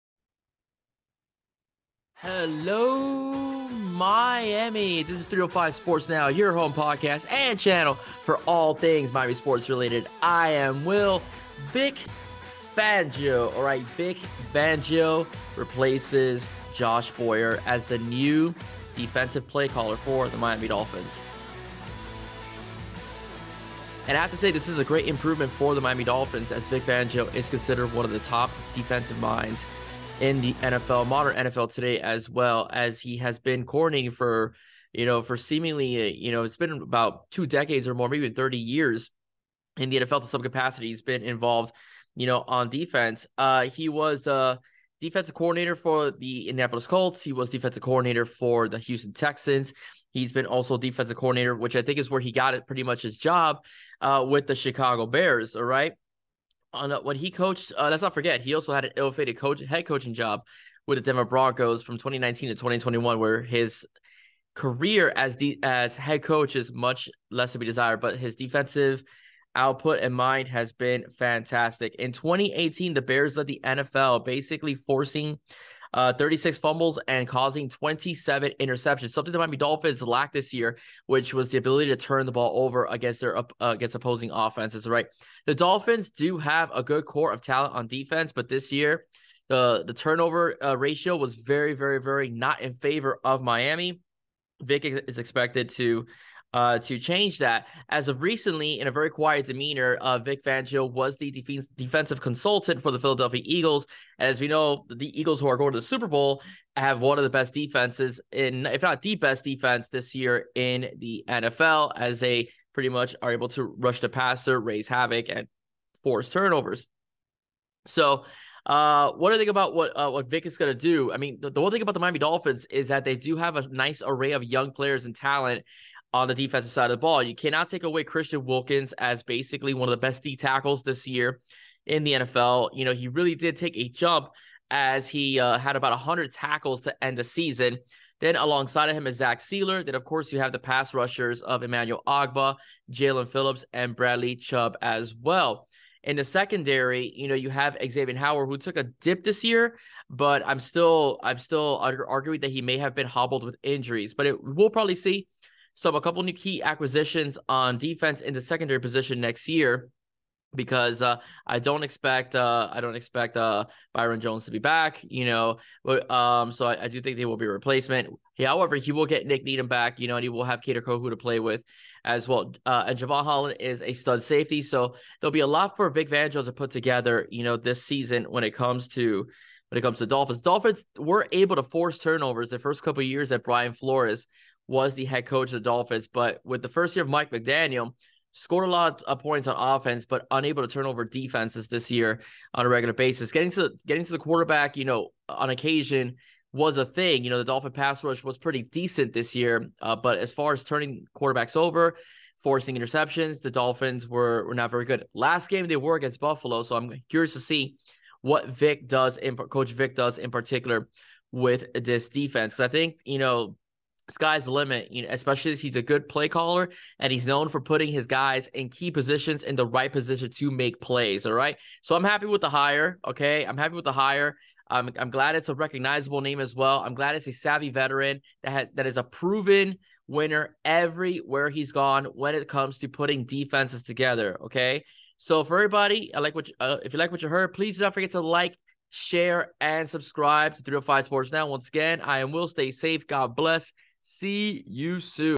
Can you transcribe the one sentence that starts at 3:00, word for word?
Dolphins were able to force turnovers the first couple years at Brian Flores was the head coach of the Dolphins.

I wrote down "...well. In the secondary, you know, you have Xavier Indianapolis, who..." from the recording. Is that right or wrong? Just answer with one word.
wrong.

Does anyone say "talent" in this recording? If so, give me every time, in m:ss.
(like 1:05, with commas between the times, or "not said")
1:27, 2:05.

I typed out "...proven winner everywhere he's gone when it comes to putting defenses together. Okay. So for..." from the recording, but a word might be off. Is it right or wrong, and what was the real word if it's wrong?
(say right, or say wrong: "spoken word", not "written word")
right.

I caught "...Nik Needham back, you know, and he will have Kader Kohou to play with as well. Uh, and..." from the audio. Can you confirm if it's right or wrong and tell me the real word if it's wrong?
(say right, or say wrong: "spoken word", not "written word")
right.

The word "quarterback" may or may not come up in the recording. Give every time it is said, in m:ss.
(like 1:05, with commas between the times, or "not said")
3:14, 3:21.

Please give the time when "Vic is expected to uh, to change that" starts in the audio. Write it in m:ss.
1:34.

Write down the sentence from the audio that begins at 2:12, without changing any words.
You know, he really did take a jump as he uh, had about 100 tackles to end the season.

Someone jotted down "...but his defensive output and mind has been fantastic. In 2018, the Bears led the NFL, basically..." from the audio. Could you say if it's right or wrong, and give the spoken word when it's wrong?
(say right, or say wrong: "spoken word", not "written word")
right.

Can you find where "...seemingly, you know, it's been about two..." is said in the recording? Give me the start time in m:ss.
0:35.